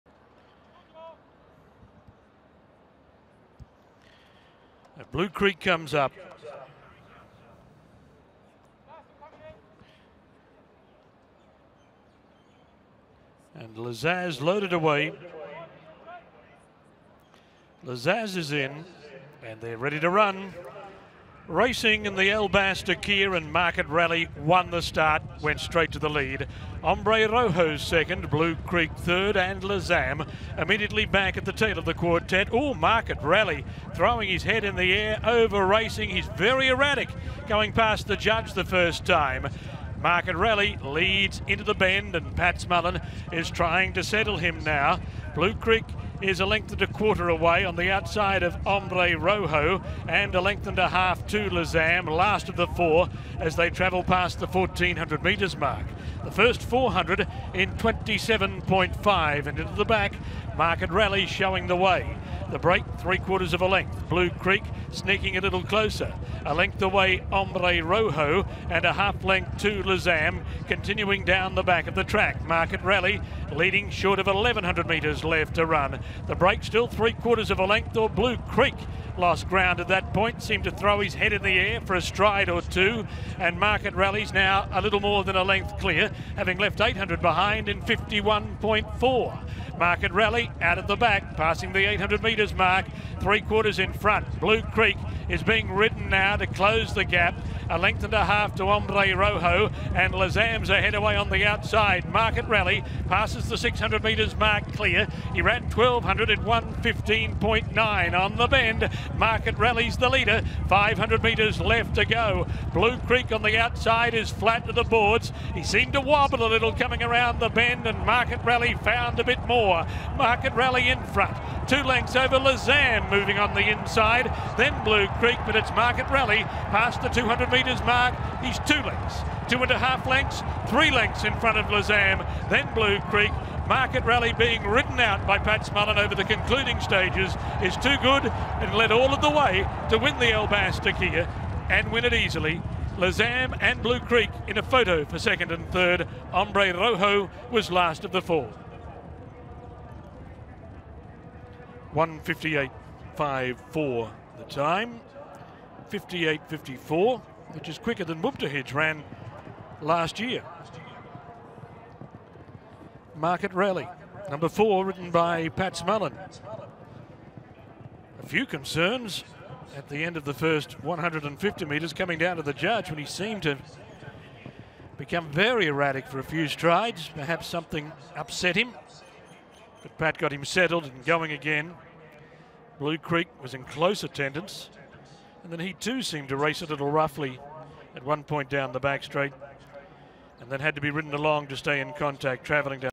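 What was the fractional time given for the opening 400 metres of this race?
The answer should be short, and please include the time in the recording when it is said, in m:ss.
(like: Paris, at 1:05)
27.5, at 0:57.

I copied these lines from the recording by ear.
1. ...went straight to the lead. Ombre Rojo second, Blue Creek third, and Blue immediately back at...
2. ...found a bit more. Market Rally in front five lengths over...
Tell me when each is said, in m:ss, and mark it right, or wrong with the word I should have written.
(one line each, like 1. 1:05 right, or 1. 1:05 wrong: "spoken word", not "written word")
1. 0:25 wrong: "Lazam", not "Blue"
2. 1:58 wrong: "two", not "five".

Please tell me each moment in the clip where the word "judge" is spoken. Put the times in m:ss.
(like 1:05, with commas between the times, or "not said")
0:38, 2:52.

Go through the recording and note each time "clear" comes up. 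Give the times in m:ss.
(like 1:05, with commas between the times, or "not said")
1:25, 1:44.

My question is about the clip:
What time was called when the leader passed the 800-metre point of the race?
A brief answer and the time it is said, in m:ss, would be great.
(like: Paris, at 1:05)
51.4, at 1:27.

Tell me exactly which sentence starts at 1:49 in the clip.
Market Rally's the leader, 500 metres left to go.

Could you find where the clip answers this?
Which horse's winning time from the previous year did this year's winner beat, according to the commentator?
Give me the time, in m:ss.
2:38.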